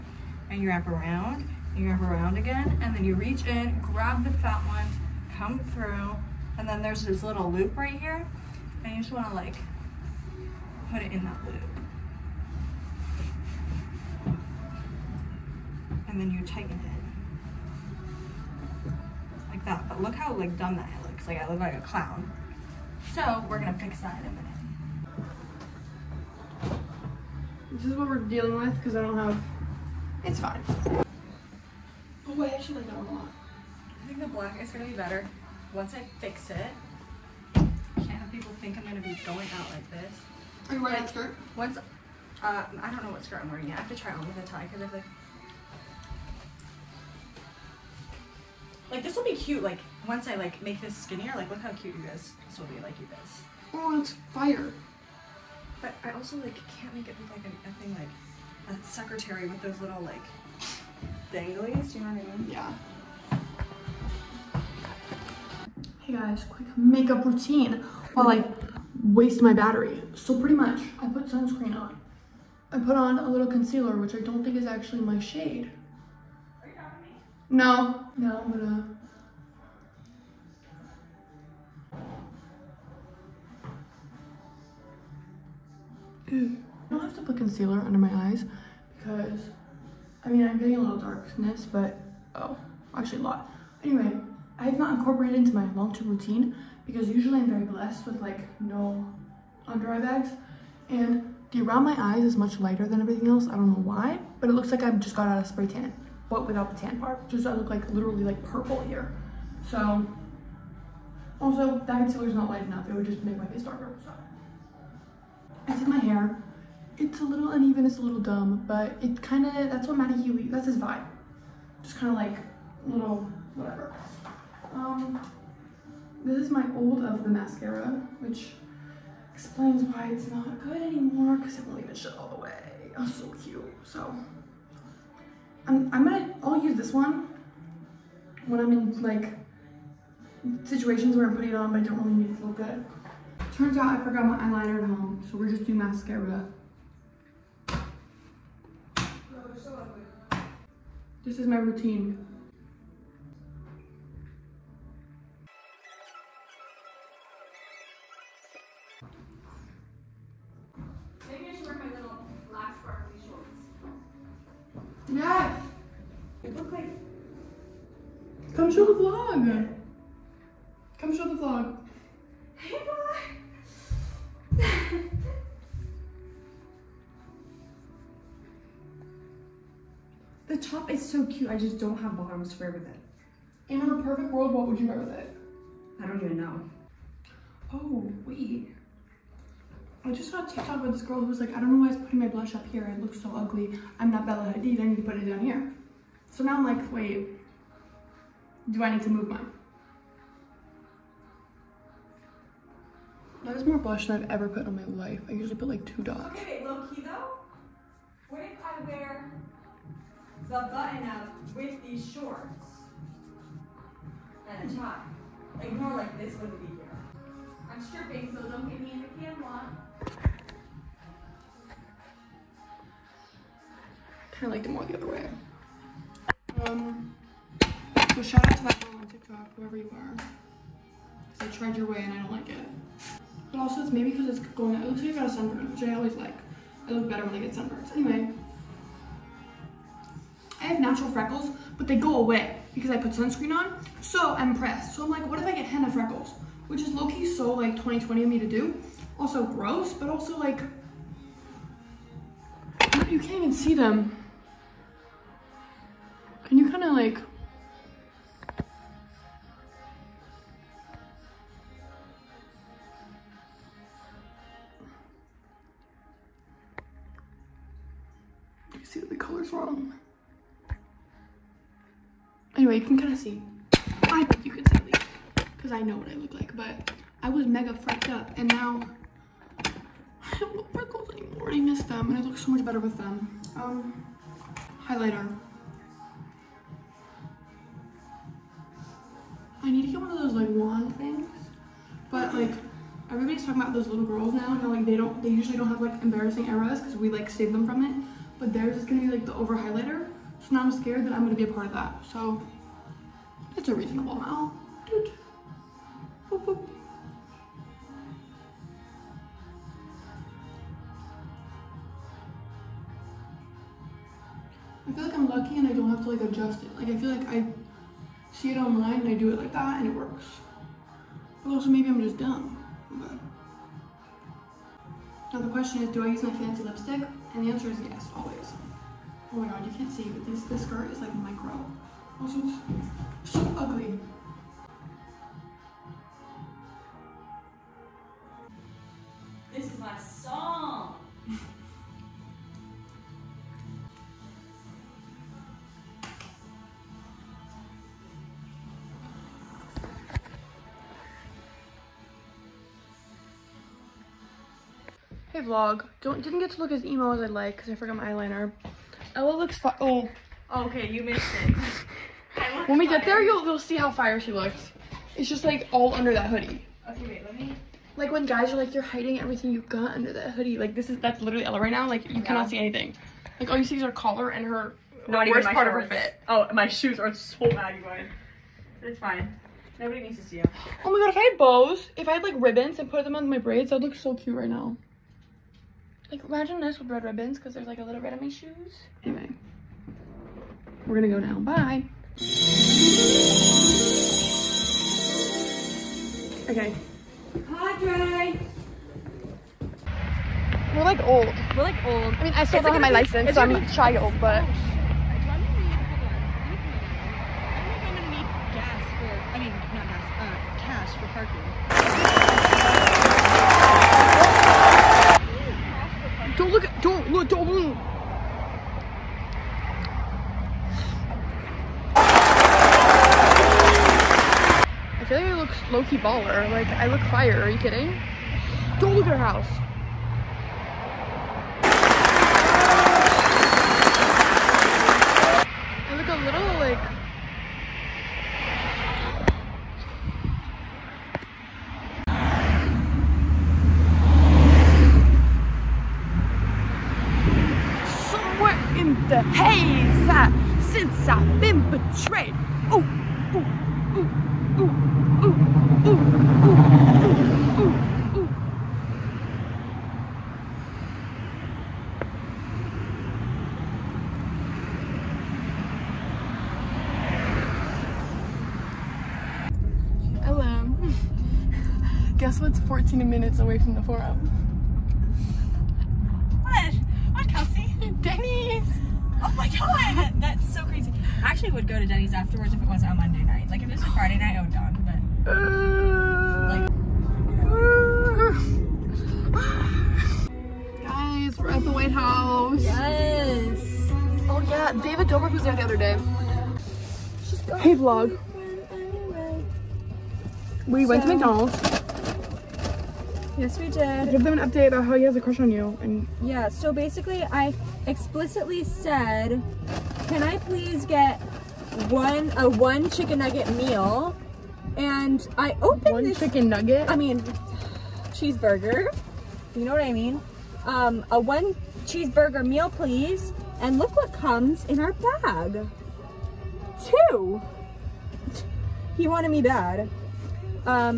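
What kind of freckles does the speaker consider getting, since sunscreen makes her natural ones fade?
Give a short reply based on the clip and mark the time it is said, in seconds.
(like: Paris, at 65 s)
Henna freckles, at 245 s.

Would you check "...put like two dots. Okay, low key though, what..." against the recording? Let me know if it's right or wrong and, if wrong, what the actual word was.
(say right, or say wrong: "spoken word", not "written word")
right.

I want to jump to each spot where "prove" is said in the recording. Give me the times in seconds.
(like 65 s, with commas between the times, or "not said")
not said.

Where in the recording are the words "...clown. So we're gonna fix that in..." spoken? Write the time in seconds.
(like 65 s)
21 s.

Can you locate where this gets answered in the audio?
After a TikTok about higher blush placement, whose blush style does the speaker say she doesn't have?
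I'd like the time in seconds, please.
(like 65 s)
194 s.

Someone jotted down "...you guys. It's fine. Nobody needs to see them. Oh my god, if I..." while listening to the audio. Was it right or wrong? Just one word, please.
right.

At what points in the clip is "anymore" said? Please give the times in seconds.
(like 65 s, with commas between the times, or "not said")
130 s, 281 s.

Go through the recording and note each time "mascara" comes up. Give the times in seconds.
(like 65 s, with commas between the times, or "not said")
127 s, 145 s.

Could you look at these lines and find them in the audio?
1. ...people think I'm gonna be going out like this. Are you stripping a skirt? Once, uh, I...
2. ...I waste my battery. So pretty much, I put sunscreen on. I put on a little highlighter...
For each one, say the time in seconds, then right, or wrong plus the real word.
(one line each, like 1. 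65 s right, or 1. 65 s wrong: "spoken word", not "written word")
1. 38 s wrong: "wearing", not "stripping"
2. 68 s wrong: "concealer", not "highlighter".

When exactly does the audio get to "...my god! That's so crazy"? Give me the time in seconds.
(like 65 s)
479 s.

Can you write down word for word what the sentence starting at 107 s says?
Just I look like literally like purple here.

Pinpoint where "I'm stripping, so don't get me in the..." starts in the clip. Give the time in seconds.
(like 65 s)
217 s.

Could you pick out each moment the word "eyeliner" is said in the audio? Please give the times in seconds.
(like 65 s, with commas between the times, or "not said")
144 s, 358 s.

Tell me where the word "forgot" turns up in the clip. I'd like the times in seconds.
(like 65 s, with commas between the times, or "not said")
144 s, 357 s.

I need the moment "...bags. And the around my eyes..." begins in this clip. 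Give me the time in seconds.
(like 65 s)
99 s.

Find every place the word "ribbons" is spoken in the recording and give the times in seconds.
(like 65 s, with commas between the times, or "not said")
382 s, 387 s.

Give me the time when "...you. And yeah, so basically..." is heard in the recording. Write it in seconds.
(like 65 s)
505 s.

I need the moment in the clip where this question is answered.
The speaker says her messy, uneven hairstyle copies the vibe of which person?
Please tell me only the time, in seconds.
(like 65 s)
119 s.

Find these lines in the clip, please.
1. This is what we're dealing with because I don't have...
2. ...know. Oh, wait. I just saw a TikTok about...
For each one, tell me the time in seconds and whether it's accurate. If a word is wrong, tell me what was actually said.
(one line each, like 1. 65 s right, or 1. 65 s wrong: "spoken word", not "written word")
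1. 27 s right
2. 186 s right.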